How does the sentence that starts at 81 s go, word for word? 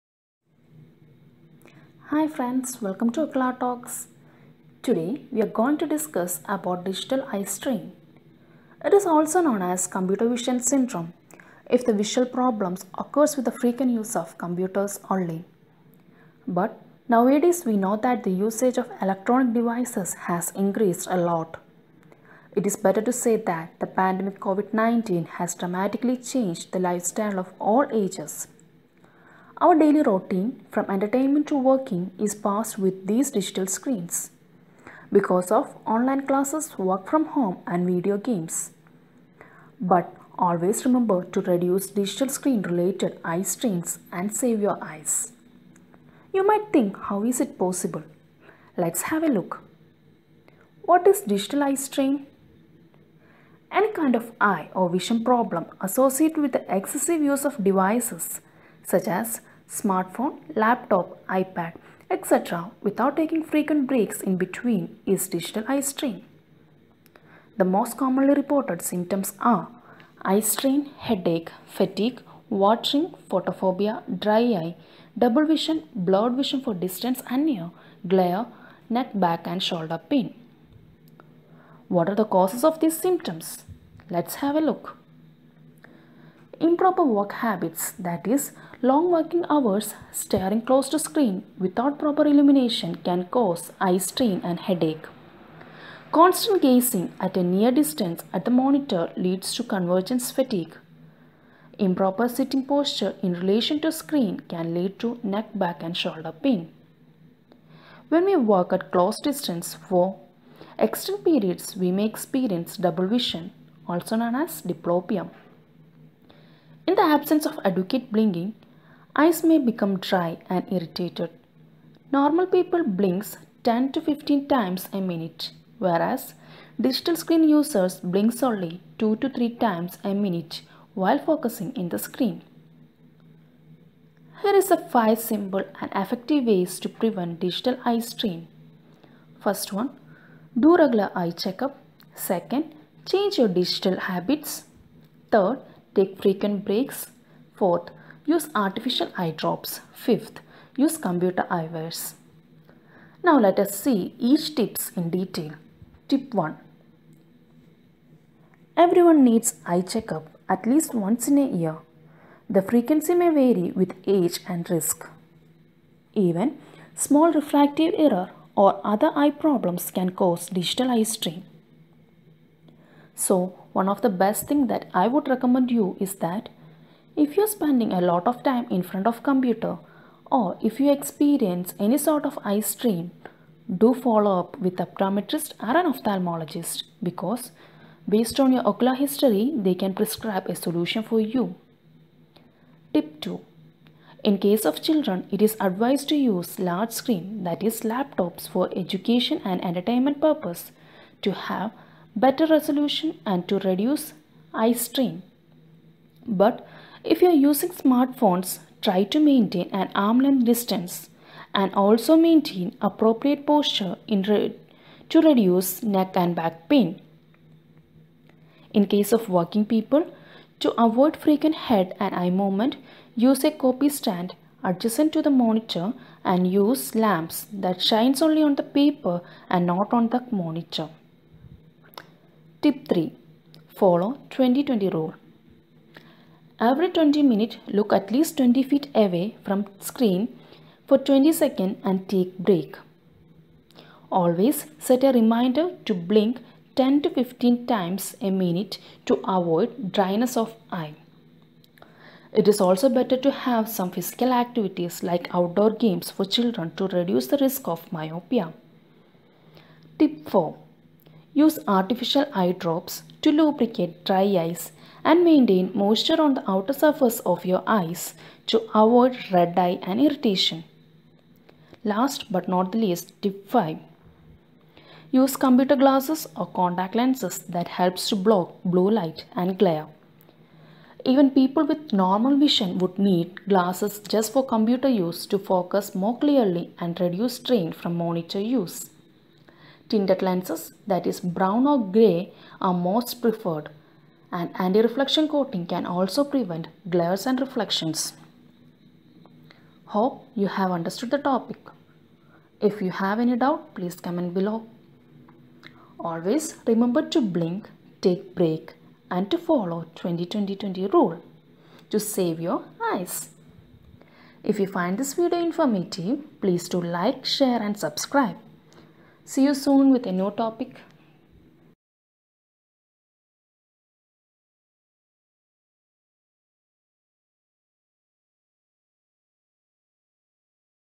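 What are the causes of these symptoms?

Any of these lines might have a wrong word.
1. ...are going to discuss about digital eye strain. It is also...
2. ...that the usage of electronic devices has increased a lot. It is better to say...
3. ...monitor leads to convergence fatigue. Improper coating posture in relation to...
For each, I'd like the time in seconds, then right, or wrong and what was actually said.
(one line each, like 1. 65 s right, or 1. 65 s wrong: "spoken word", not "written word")
1. 5 s right
2. 17 s right
3. 98 s wrong: "sitting", not "coating".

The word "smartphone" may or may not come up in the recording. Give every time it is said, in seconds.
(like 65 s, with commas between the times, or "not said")
59 s, 207 s.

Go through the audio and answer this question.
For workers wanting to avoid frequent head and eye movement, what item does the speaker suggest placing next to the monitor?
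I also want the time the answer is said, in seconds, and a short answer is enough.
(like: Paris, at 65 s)
copy stand, at 223 s.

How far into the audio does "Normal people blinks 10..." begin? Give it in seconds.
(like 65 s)
122 s.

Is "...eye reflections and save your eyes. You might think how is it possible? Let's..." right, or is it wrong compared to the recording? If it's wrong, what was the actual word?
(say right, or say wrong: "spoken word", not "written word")
wrong: "strains", not "reflections".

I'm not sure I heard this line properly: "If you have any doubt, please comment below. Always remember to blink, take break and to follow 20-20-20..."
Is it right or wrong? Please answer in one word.
right.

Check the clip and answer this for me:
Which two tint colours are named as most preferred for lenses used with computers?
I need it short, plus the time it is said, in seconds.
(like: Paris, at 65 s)
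brown or grey, at 291 s.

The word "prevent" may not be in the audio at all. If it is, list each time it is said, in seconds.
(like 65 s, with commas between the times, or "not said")
136 s, 296 s.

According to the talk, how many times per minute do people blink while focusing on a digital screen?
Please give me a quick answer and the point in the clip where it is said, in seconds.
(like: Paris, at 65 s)
2 to 3, at 128 s.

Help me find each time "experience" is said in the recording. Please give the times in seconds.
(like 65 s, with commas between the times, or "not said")
112 s, 180 s.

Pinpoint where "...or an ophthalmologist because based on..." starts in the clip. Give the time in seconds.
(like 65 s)
185 s.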